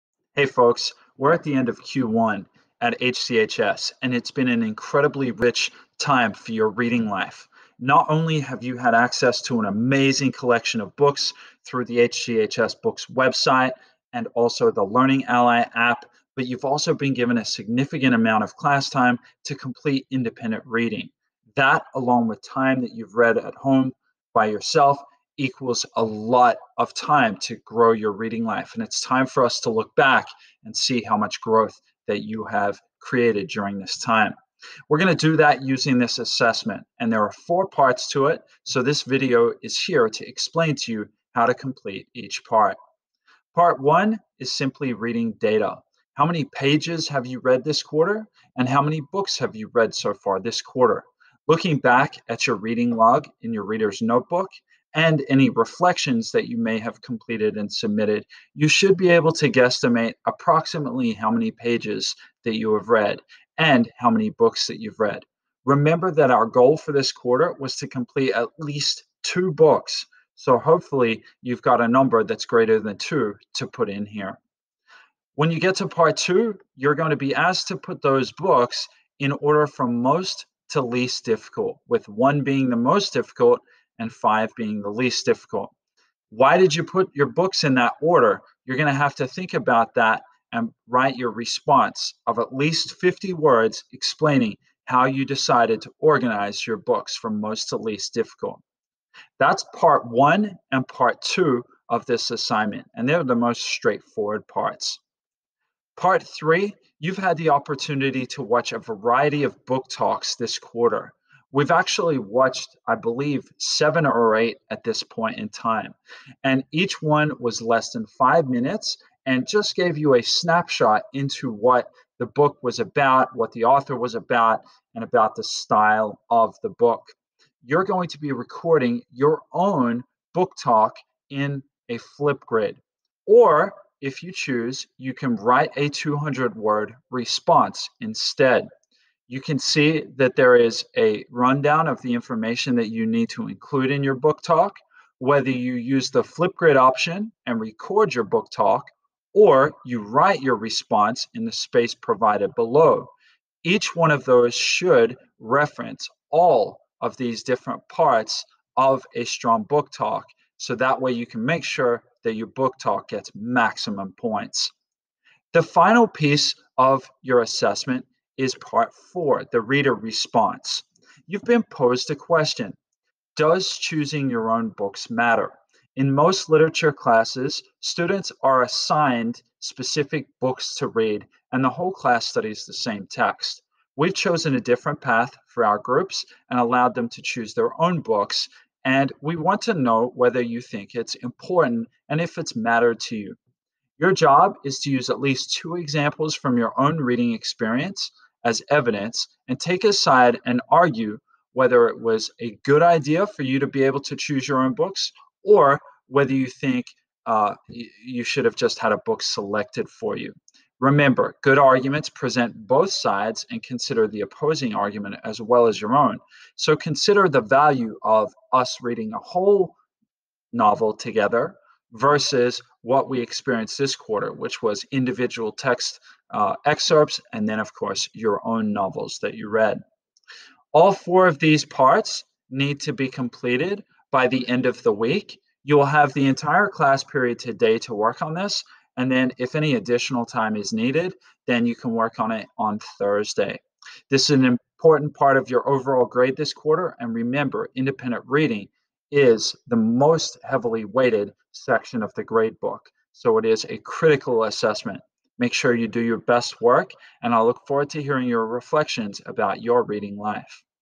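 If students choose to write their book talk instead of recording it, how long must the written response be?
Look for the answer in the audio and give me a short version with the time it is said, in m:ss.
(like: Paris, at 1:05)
200 words, at 2:15.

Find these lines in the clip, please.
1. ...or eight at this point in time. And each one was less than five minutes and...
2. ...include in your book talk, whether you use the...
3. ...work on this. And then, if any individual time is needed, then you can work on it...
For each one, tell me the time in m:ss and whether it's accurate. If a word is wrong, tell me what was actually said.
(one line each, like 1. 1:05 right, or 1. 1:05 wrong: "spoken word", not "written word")
1. 1:54 right
2. 2:23 right
3. 3:57 wrong: "additional", not "individual".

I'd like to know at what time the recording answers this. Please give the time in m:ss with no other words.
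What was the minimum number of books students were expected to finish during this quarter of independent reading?
1:08.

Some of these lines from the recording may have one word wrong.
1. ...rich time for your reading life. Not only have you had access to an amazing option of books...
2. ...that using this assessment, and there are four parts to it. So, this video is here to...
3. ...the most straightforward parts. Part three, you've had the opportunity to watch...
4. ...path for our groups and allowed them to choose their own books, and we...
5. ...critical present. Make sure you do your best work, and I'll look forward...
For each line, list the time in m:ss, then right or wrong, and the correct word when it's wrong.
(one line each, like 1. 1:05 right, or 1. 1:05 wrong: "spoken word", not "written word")
1. 0:05 wrong: "collection", not "option"
2. 0:35 right
3. 1:43 right
4. 3:05 right
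5. 4:13 wrong: "assessment", not "present".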